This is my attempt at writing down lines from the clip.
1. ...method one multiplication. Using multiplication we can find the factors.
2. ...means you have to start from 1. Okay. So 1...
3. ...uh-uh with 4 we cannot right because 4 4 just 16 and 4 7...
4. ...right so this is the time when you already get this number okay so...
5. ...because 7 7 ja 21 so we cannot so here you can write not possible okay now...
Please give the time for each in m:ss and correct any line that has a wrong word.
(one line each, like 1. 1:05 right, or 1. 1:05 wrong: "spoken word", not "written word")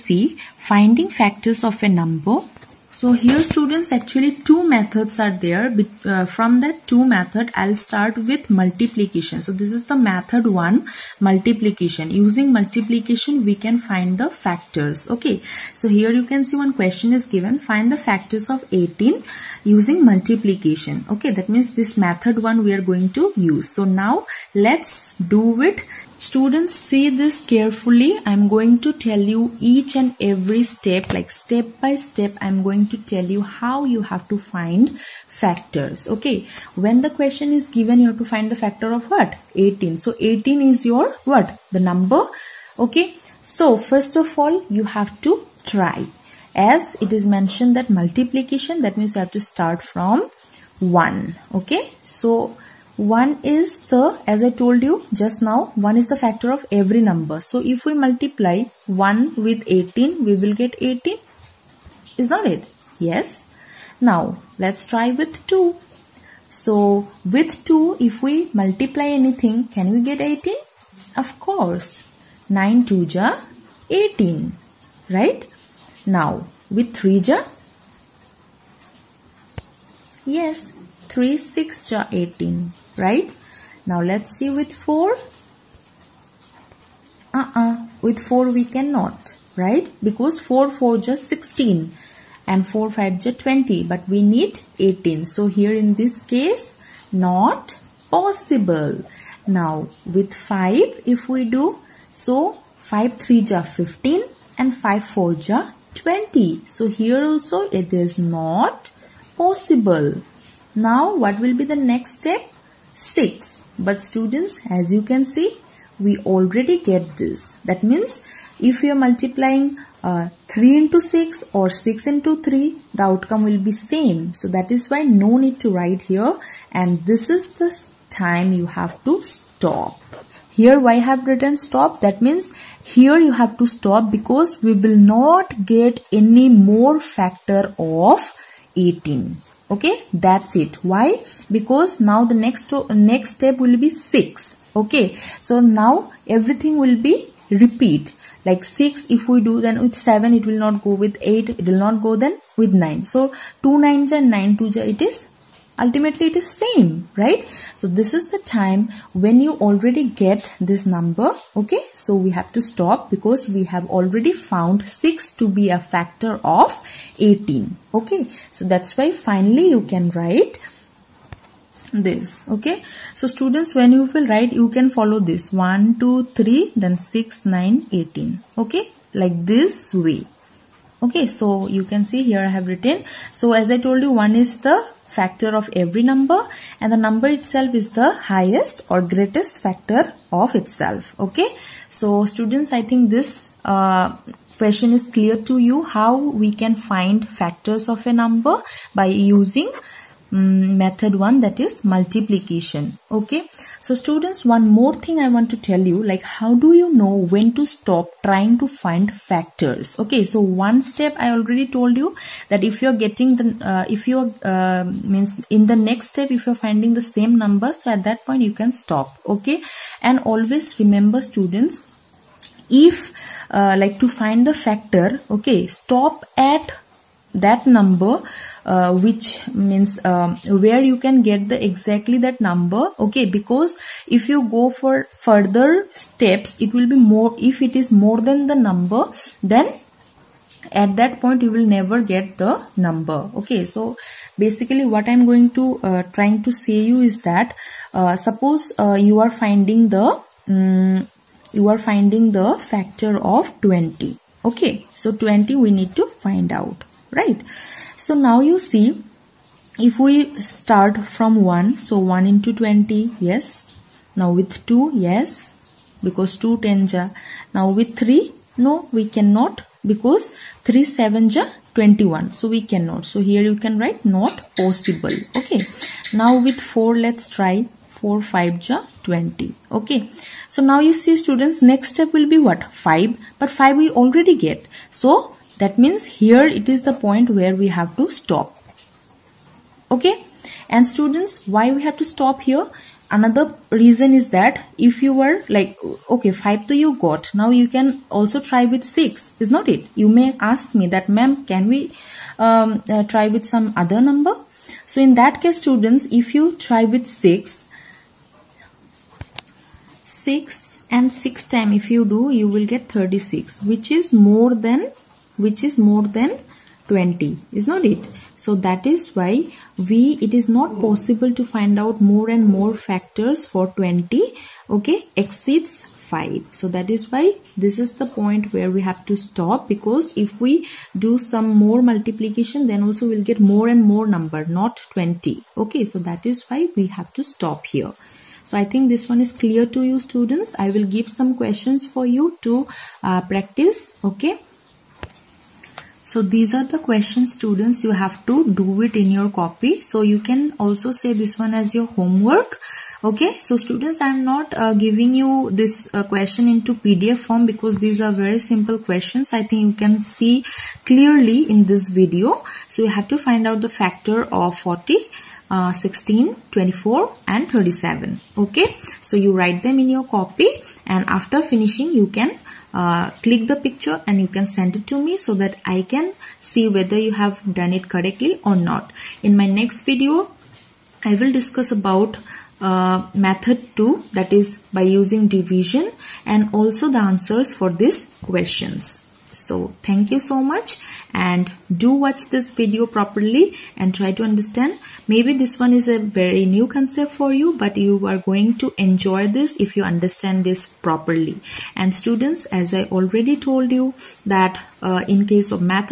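1. 0:09 right
2. 0:48 right
3. 1:27 wrong: "5", not "7"
4. 2:37 right
5. 4:29 wrong: "3", not "7".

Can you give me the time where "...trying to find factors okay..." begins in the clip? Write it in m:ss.
3:28.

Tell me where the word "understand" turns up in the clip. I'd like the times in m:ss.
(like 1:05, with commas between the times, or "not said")
6:34, 6:39.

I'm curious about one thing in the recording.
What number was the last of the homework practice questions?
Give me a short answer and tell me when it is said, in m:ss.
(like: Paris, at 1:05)
37, at 6:07.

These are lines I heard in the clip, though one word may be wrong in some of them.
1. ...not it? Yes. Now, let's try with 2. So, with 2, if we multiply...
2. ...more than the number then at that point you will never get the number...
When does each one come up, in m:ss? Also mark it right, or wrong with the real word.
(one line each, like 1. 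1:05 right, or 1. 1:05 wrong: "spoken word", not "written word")
1. 1:02 right
2. 3:57 right.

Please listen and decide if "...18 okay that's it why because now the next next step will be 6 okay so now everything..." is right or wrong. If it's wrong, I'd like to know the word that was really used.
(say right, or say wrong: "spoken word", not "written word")
right.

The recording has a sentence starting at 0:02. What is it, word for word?
So here students actually two methods are there.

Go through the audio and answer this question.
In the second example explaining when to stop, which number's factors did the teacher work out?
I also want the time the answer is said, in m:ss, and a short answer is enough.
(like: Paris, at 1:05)
20, at 4:11.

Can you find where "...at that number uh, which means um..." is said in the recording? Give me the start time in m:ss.
3:46.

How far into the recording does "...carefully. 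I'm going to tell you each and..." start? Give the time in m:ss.
0:27.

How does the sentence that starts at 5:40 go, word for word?
I will give some questions for you to uh, practice.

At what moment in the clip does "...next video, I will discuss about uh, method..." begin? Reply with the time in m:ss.
6:19.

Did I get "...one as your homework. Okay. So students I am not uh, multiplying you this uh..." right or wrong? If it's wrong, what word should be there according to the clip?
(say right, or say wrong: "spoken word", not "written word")
wrong: "giving", not "multiplying".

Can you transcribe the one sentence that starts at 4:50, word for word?
And students, why we have to stop here?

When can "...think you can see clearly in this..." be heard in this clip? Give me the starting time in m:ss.
5:59.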